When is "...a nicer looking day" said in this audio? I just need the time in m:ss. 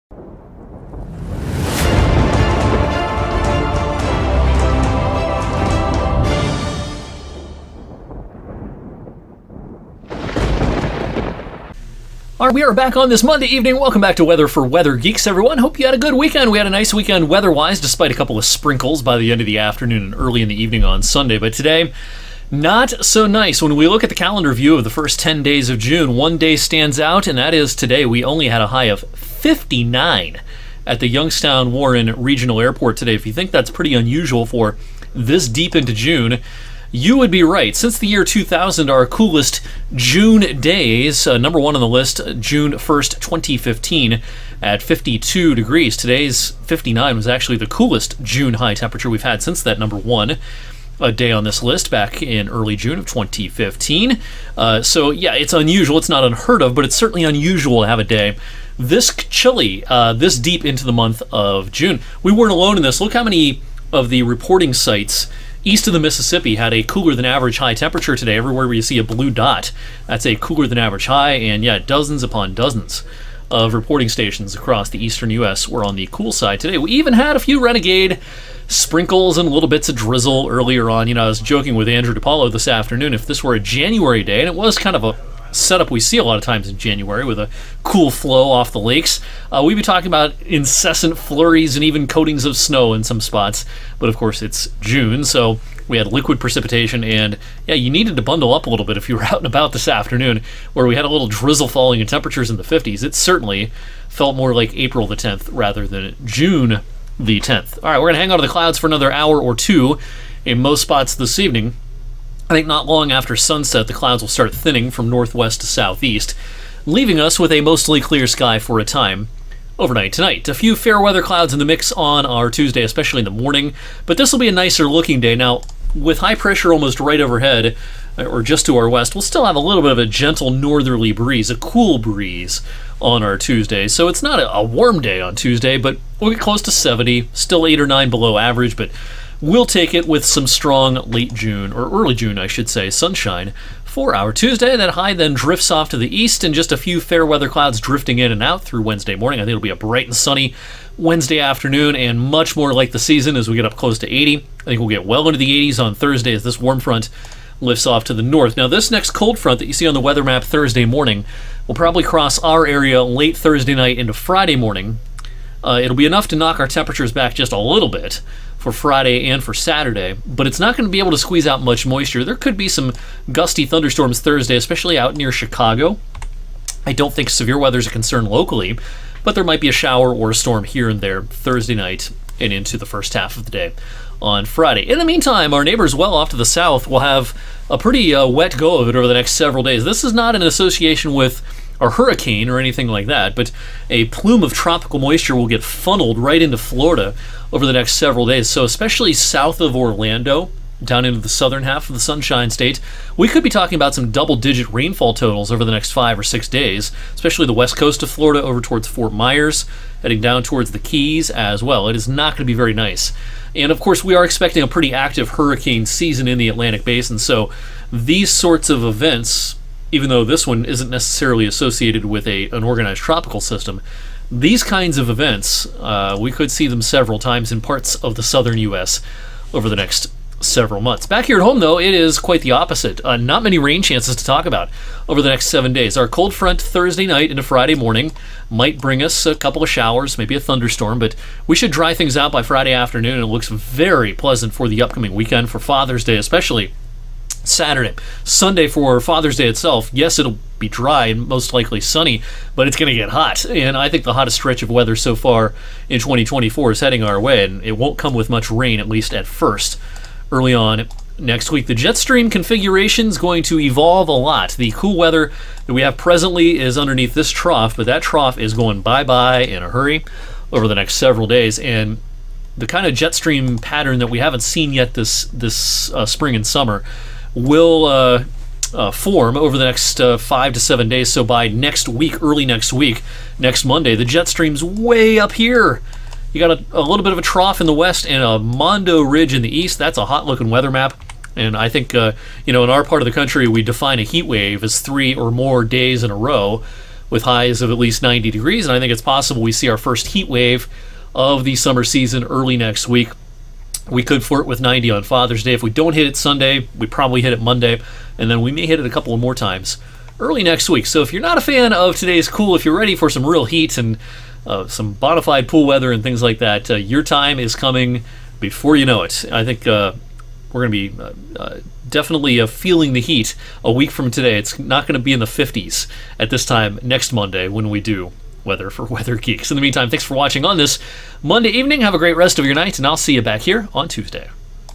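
2:04.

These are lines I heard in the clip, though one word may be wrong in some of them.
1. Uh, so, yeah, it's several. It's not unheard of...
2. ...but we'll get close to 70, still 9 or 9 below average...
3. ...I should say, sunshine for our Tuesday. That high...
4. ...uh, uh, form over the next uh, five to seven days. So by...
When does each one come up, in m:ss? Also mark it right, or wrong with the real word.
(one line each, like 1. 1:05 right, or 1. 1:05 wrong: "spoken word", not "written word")
1. 0:54 wrong: "unusual", not "several"
2. 2:15 wrong: "8", not "9"
3. 2:22 right
4. 4:37 right.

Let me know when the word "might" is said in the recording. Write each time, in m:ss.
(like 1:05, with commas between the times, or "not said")
2:59, 3:58.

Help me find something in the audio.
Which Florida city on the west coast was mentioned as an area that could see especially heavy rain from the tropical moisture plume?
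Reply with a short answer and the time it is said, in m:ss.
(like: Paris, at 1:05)
Fort Myers, at 3:28.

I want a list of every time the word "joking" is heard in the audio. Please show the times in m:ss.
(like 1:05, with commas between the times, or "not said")
1:21.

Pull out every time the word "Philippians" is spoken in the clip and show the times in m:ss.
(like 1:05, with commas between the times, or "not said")
not said.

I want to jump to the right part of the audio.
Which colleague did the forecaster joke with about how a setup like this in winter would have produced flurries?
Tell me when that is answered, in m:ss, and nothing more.
1:21.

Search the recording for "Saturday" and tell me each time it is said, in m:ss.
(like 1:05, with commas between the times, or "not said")
2:49, 4:07.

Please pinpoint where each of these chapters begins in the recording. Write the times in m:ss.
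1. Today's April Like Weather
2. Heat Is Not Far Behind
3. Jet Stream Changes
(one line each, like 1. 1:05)
1. 0:25
2. 2:00
3. 3:55.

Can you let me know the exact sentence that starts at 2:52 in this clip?
There could be some gusty thunderstorms Thursday, especially out near Chicago.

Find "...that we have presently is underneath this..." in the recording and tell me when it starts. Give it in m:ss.
4:25.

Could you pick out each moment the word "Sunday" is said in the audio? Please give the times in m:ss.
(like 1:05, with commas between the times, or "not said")
0:21, 4:08, 5:06.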